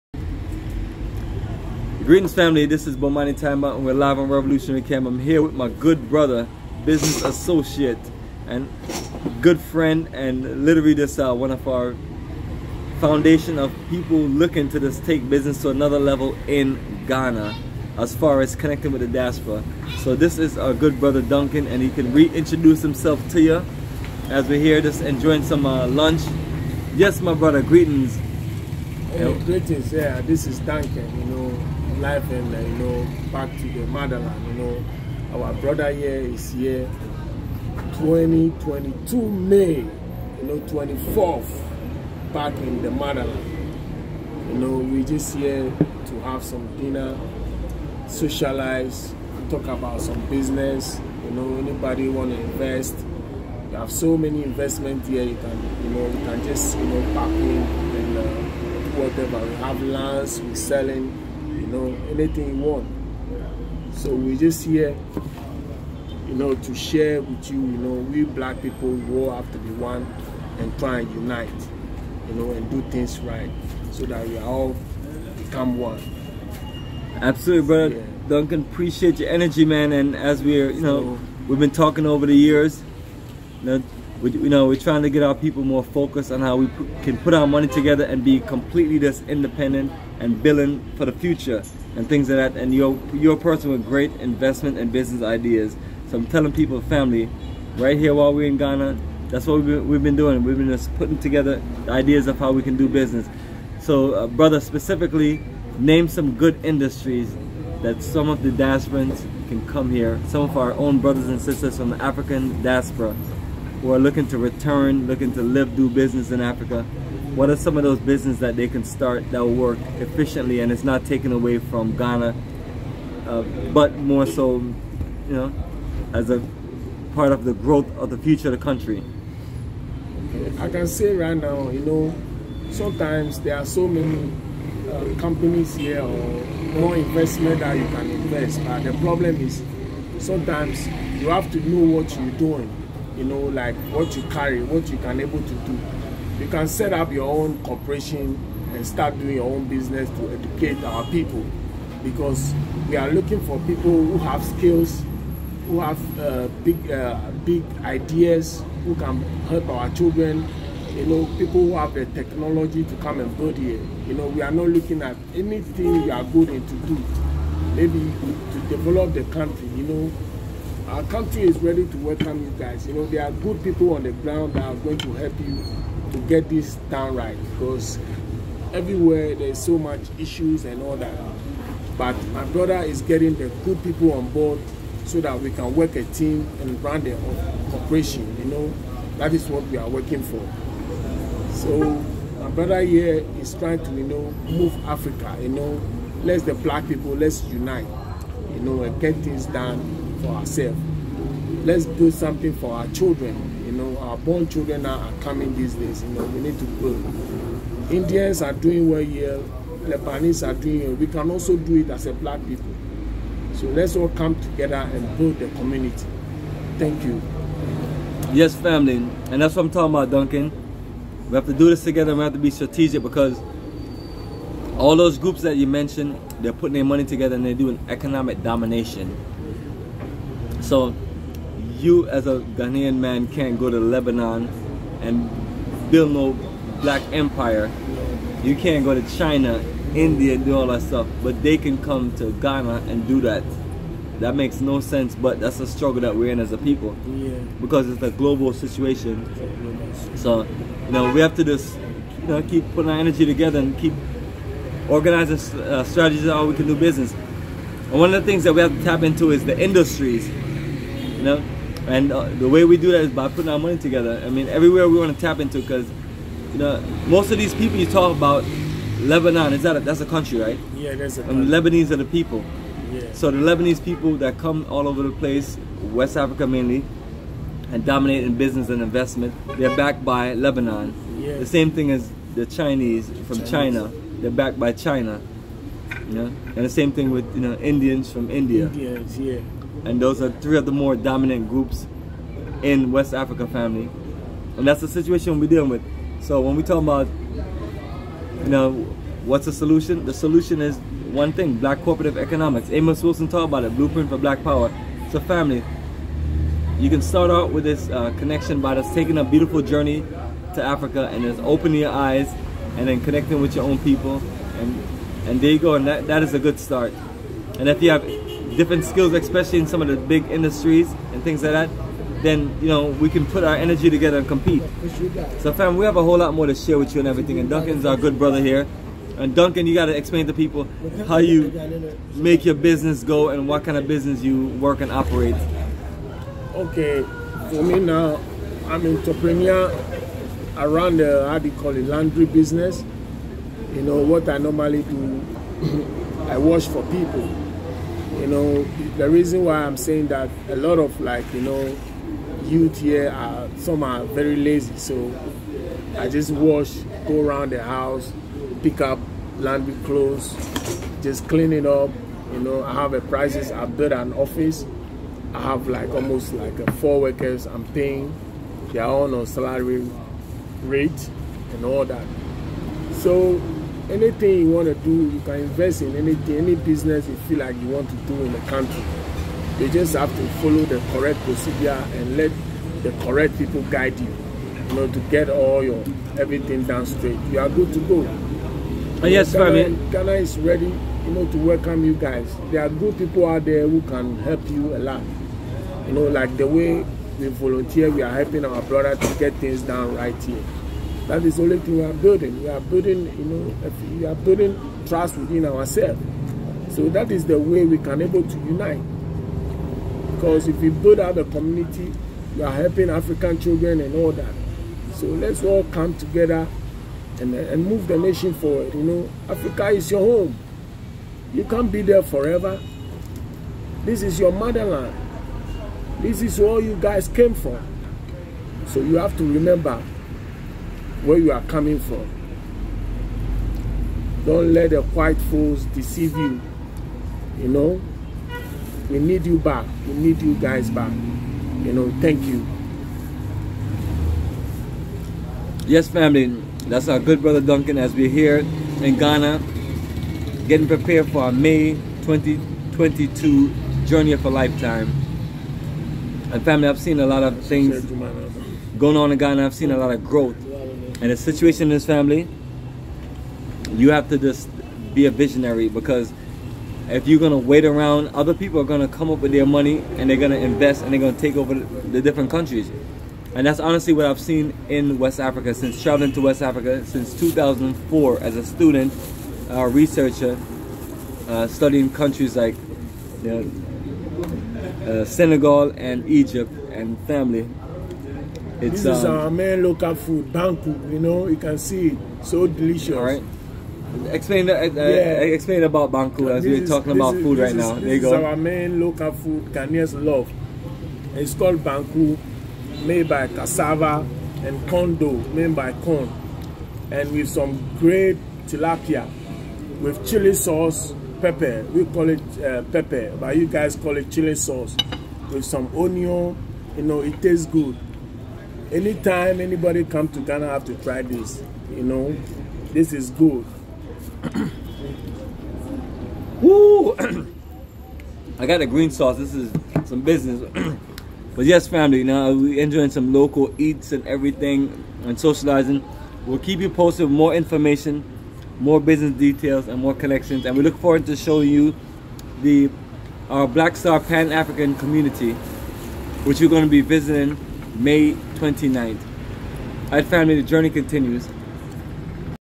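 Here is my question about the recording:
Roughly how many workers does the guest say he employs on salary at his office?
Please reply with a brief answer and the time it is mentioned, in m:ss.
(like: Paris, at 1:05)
4, at 6:06.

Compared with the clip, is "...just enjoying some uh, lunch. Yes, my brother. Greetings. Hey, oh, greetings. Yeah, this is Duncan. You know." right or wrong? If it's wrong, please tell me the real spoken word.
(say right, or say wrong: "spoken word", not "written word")
right.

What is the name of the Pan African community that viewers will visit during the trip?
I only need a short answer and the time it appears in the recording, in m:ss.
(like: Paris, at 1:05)
Black Star, at 9:03.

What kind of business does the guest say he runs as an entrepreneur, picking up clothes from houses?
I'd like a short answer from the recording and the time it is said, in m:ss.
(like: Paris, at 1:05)
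Laundry business, at 5:41.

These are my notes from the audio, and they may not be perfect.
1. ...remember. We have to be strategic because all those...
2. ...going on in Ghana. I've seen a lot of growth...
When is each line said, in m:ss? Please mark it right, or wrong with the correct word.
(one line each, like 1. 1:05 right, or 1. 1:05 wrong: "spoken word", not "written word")
1. 3:41 wrong: "together", not "remember"
2. 7:38 right.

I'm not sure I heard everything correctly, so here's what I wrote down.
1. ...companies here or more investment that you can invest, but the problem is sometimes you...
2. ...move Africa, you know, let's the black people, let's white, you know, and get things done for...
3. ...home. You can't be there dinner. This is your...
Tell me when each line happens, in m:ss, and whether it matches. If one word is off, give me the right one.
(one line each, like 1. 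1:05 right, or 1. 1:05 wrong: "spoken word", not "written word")
1. 2:15 right
2. 3:14 wrong: "unite", not "white"
3. 6:59 wrong: "forever", not "dinner".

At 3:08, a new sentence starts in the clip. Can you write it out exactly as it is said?
You know, that is what we are working for.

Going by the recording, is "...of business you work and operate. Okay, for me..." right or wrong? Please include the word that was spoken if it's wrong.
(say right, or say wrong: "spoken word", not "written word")
right.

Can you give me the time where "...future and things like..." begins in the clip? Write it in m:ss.
1:31.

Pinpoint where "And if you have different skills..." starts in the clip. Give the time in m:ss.
5:17.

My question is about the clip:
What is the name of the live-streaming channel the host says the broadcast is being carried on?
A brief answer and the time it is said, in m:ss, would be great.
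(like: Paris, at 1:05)
Revolutionary Cam, at 0:04.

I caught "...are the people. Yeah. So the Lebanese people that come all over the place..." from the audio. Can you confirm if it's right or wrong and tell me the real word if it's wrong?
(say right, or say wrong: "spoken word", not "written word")
right.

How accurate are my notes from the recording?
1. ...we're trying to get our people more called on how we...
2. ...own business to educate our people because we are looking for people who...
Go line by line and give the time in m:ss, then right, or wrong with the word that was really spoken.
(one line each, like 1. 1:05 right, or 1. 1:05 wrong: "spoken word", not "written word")
1. 1:24 wrong: "focused", not "called"
2. 2:29 right.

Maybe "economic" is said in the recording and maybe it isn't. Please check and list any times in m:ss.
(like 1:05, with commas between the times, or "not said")
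3:47, 5:02.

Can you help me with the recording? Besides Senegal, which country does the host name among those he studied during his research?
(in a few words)
Egypt.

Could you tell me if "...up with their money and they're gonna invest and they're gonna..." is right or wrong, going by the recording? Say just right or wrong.
right.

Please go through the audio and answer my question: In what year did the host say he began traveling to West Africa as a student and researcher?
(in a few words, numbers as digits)
2004.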